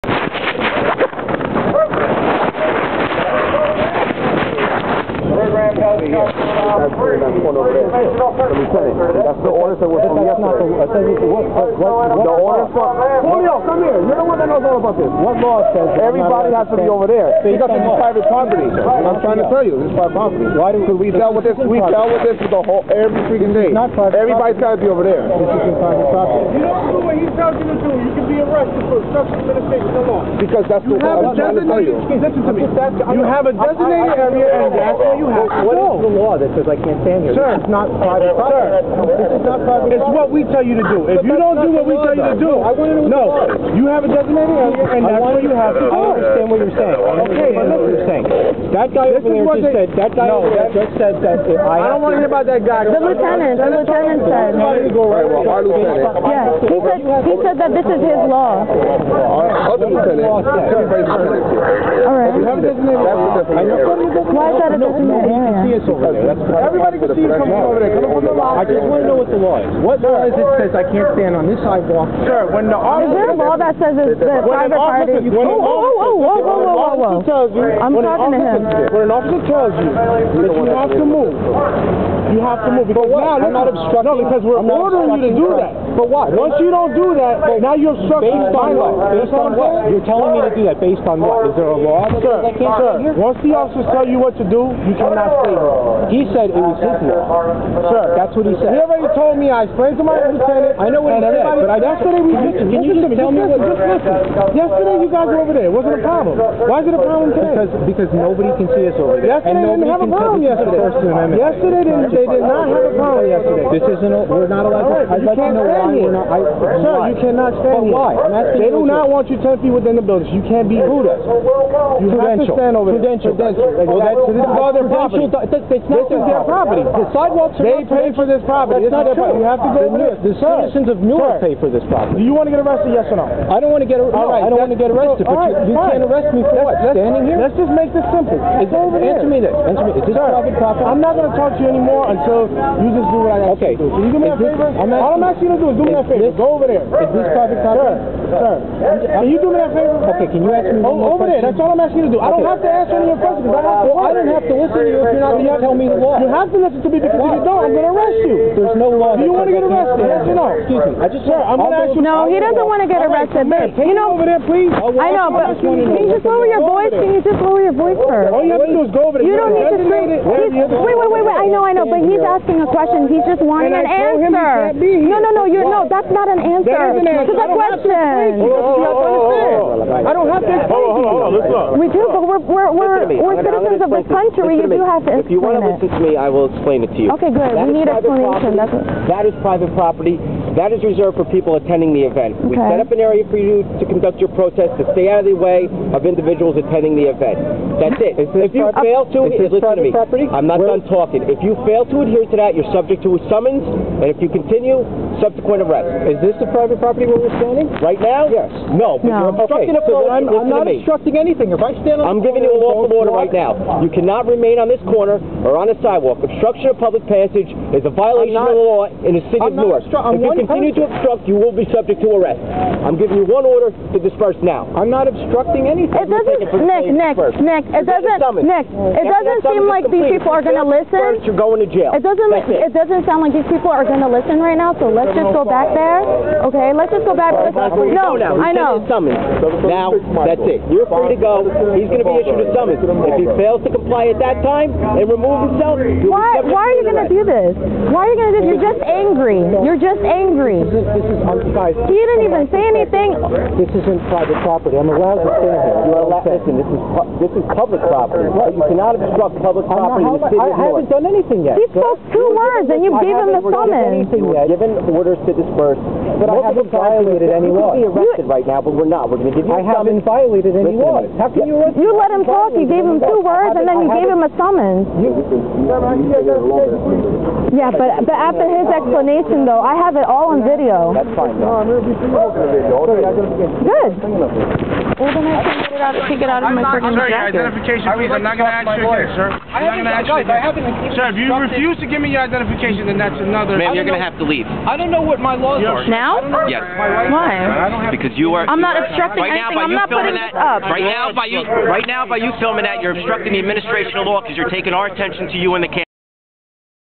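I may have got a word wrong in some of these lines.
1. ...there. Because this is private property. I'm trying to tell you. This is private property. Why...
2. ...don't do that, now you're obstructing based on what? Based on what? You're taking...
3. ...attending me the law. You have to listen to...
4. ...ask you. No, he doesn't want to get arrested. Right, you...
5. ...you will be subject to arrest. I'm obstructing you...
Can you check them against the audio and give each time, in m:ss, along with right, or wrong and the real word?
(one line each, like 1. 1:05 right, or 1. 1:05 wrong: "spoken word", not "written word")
1. 0:17 right
2. 1:26 wrong: "telling", not "taking"
3. 2:35 wrong: "telling", not "attending"
4. 2:41 right
5. 3:41 wrong: "giving", not "obstructing".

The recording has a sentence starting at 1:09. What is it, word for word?
What law is it that says I can't stand on this sidewalk?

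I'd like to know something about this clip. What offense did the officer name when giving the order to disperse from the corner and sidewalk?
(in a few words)
Obstruction of public passage.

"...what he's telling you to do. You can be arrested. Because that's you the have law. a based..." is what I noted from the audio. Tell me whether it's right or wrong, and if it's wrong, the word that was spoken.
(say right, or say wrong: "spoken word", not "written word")
wrong: "designated", not "based".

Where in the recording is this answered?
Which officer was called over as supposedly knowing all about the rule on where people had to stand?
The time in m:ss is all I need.
0:13.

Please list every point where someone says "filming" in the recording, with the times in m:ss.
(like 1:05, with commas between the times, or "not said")
5:02.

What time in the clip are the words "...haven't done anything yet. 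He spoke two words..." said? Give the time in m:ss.
4:20.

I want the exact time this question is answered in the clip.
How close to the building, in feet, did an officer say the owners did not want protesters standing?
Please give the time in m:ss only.
1:59.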